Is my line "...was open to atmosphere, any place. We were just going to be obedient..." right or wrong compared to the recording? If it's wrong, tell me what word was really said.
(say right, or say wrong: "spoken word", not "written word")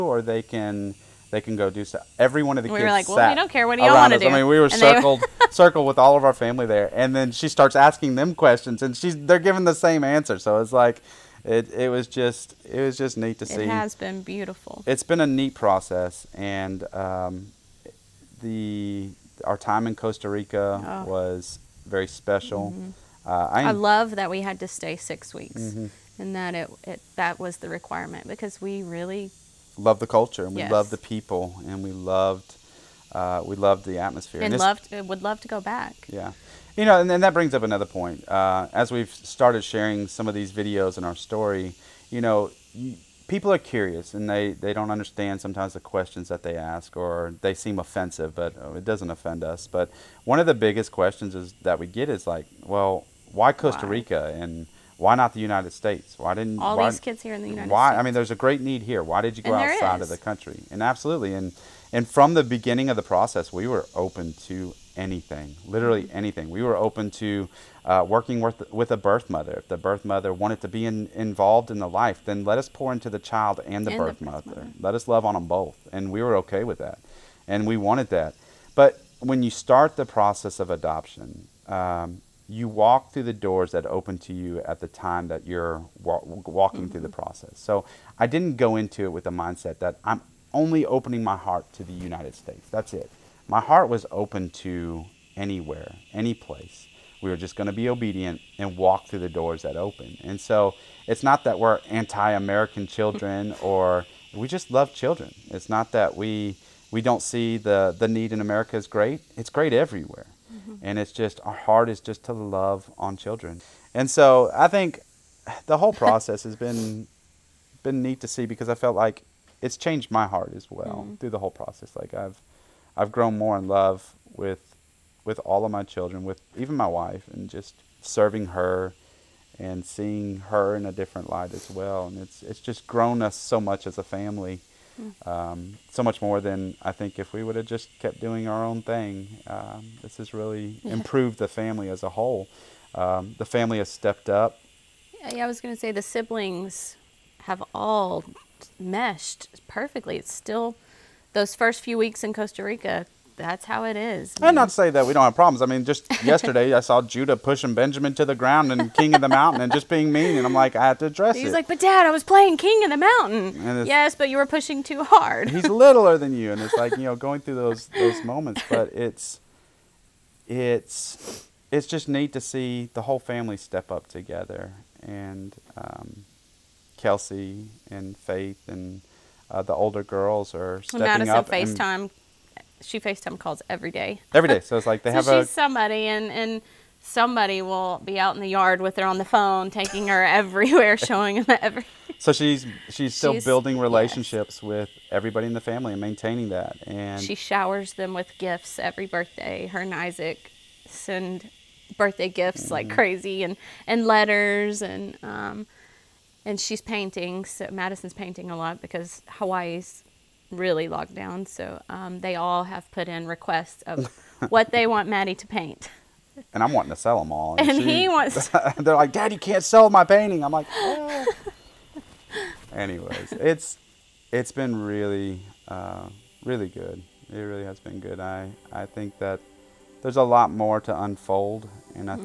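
wrong: "anywhere", not "atmosphere".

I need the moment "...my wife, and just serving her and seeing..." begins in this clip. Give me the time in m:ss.
2:06.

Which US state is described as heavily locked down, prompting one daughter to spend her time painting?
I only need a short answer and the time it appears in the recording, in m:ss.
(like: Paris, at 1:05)
Hawaii, at 3:29.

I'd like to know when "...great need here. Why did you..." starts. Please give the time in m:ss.
0:58.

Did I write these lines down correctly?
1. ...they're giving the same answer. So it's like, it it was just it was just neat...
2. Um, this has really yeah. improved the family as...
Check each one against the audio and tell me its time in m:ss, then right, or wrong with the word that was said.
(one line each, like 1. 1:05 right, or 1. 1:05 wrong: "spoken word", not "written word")
1. 0:09 right
2. 2:19 right.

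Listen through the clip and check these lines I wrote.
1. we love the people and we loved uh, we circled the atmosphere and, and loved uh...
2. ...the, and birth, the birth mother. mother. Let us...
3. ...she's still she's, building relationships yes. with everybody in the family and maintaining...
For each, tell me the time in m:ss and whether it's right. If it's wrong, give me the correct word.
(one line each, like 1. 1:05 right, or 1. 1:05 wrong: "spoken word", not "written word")
1. 0:30 wrong: "loved", not "circled"
2. 1:13 right
3. 3:12 right.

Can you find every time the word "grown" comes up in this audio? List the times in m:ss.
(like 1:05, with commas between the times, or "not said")
2:03, 2:12.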